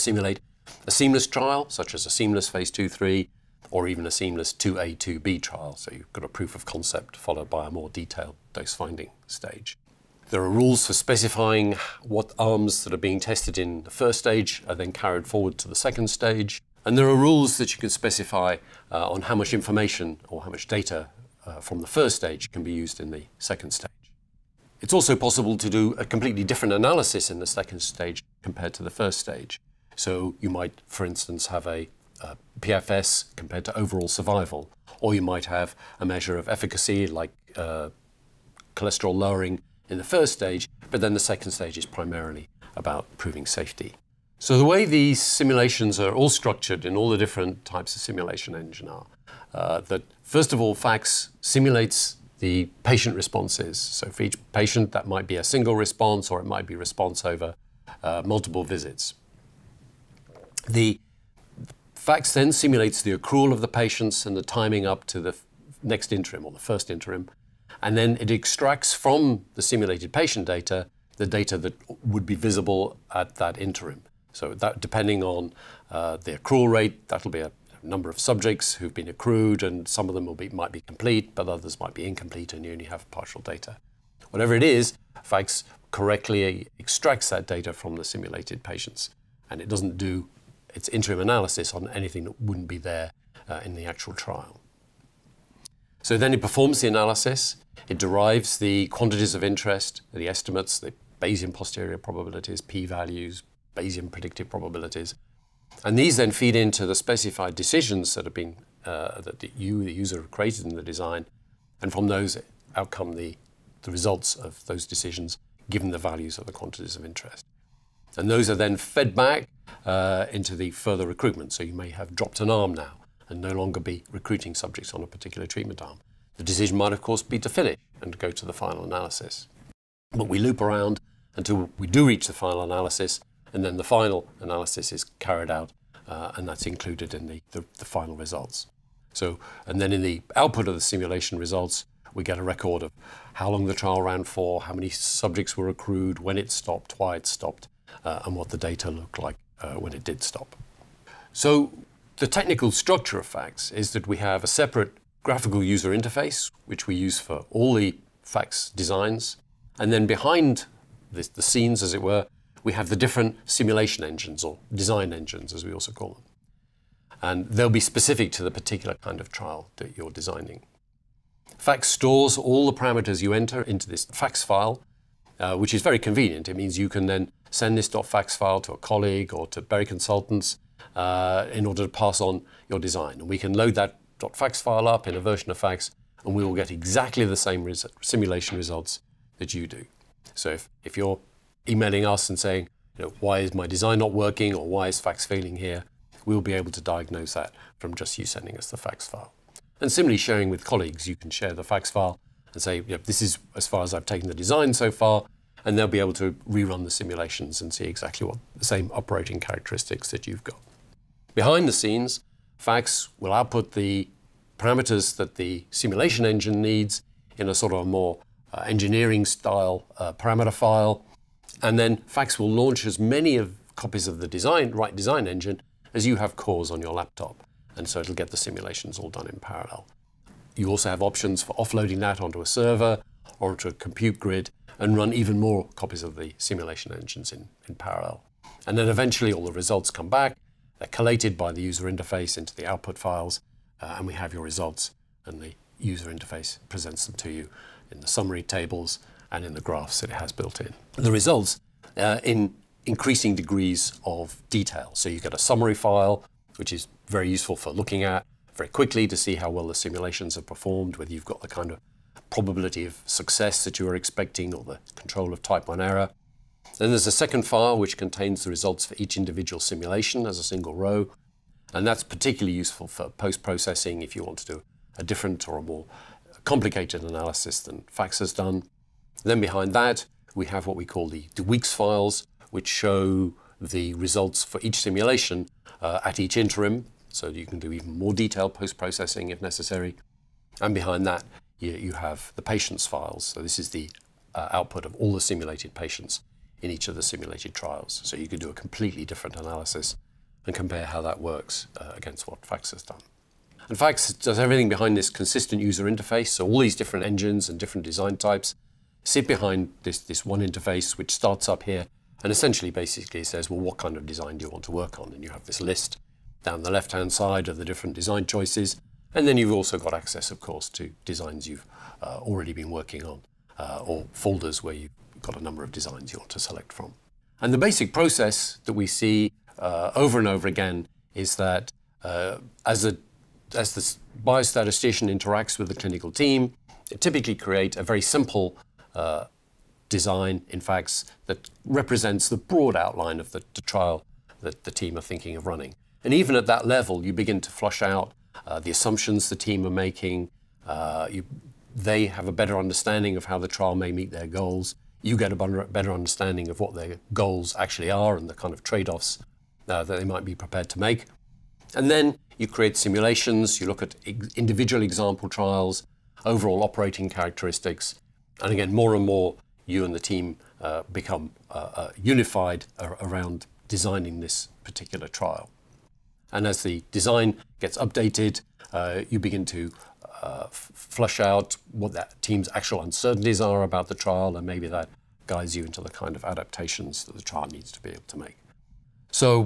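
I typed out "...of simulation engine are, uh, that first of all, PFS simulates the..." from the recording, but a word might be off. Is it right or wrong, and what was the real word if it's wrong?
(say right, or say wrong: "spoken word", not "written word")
wrong: "FACTS", not "PFS".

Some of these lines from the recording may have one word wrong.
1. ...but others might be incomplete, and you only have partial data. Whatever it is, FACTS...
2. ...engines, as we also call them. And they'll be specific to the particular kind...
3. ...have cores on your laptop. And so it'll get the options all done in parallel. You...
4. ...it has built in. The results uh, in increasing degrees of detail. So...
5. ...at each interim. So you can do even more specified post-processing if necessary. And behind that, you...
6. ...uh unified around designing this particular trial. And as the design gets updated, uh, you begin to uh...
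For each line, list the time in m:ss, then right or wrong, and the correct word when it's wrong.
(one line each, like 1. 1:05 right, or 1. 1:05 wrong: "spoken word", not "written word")
1. 1:21 right
2. 2:45 right
3. 3:46 wrong: "simulations", not "options"
4. 4:10 right
5. 4:46 wrong: "detailed", not "specified"
6. 6:11 right.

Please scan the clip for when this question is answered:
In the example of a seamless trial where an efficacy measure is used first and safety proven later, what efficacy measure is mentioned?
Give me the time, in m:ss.
0:38.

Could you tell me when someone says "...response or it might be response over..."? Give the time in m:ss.
0:55.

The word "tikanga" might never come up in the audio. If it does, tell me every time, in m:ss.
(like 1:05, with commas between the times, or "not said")
not said.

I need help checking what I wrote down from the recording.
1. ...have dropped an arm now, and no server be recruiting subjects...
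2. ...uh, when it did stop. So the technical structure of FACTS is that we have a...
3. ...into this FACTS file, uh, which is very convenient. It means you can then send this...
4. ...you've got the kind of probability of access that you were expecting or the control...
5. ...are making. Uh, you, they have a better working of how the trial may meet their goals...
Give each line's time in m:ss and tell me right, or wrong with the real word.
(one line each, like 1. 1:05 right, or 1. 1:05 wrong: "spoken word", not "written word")
1. 2:01 wrong: "longer", not "server"
2. 2:29 right
3. 2:53 right
4. 4:21 wrong: "success", not "access"
5. 5:49 wrong: "understanding", not "working".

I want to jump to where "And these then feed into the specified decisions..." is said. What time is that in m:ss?
1:45.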